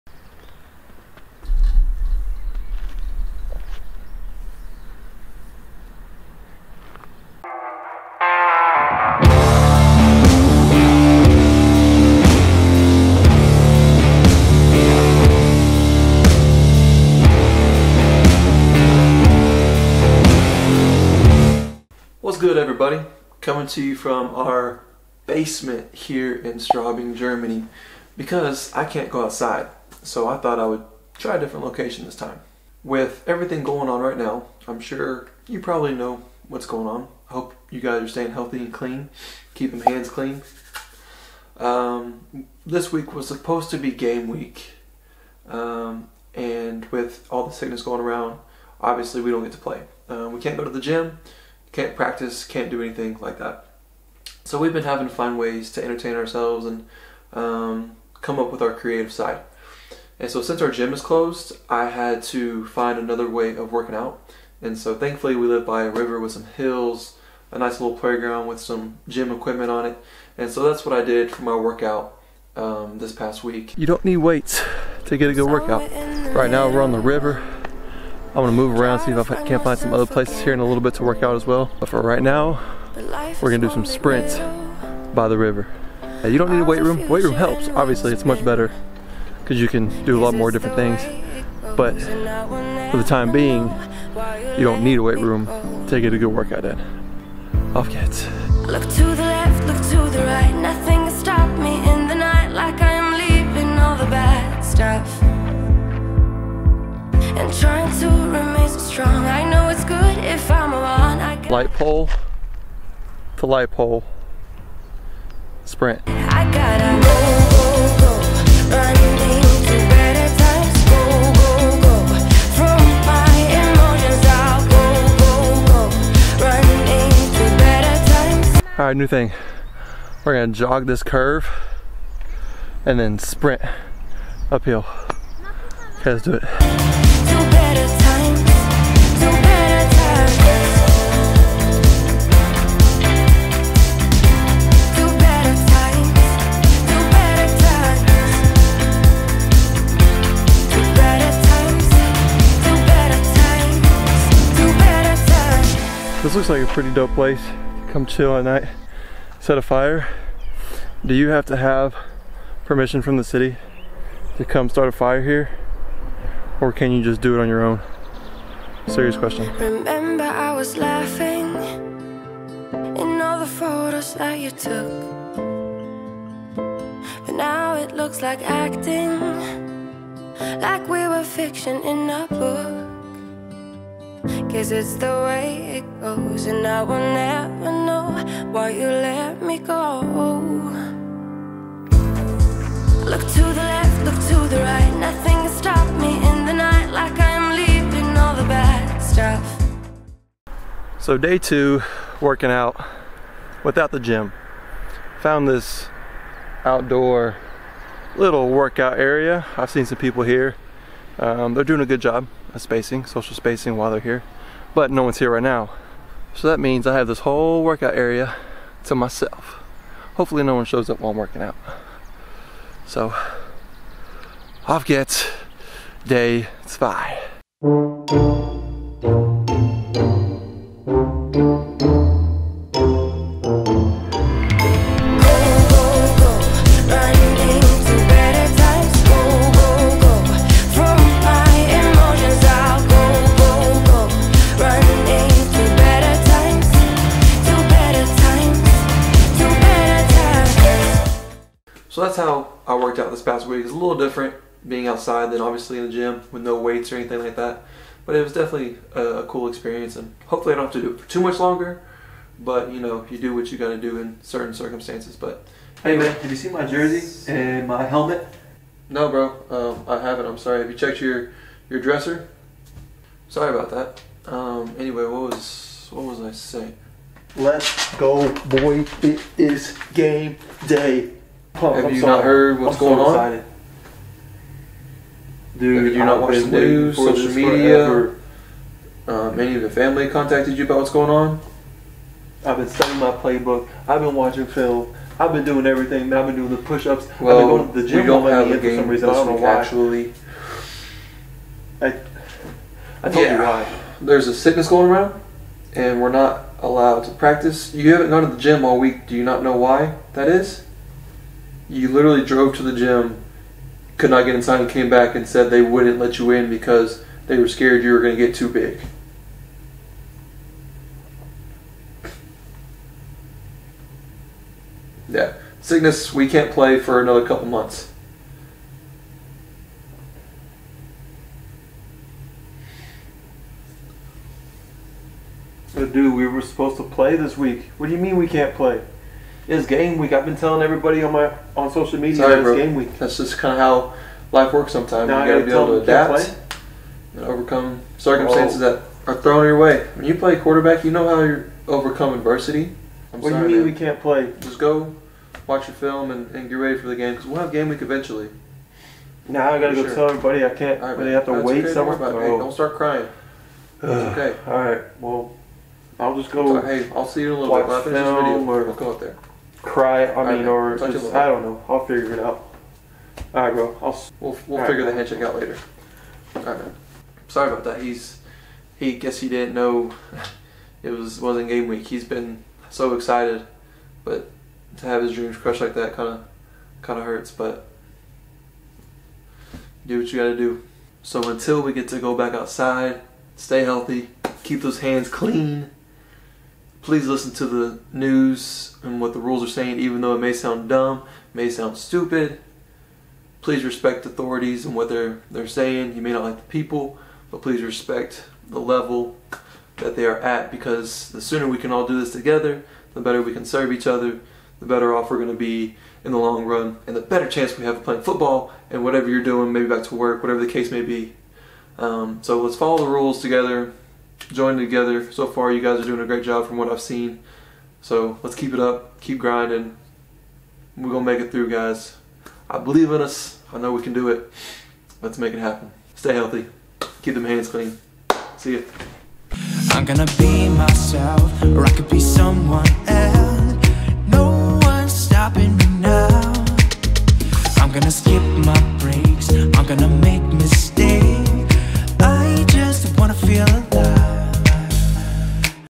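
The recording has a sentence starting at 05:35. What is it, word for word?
Dude, we were supposed to play this week.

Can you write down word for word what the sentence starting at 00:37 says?
I hope you guys are staying healthy and clean, keep them hands clean.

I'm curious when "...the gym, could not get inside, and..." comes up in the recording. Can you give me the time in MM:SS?
05:12.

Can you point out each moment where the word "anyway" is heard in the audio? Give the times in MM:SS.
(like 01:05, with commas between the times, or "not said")
04:34.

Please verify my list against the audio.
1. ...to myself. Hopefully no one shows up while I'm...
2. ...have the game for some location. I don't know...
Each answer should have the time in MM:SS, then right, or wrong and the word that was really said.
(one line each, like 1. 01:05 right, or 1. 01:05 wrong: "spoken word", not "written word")
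1. 03:38 right
2. 04:58 wrong: "reason", not "location".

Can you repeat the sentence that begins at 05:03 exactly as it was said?
There's a sickness going around, and we're not allowed to practice.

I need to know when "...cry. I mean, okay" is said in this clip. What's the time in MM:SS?
06:09.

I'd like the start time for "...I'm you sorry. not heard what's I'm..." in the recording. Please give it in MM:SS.
04:41.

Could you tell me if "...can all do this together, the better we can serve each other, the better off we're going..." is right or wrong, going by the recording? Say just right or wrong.
right.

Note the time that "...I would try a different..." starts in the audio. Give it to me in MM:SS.
00:30.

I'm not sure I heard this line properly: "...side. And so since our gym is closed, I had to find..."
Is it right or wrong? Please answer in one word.
right.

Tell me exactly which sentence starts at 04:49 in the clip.
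Um, any of the family contacted you about what's going on?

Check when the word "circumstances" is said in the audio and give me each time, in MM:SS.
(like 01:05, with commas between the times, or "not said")
04:24, 05:47.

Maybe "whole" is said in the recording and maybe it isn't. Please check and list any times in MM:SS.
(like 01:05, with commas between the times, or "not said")
03:37.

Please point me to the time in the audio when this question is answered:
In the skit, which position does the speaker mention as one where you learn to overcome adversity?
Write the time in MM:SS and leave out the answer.
05:50.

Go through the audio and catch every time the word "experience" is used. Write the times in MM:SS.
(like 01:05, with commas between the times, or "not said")
04:19.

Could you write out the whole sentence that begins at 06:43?
Please respect authorities and what they're, they're saying.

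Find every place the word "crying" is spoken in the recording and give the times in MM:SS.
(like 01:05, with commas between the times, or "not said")
06:02.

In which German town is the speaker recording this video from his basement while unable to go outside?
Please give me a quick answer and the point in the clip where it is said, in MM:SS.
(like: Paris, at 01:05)
Straubing, at 00:26.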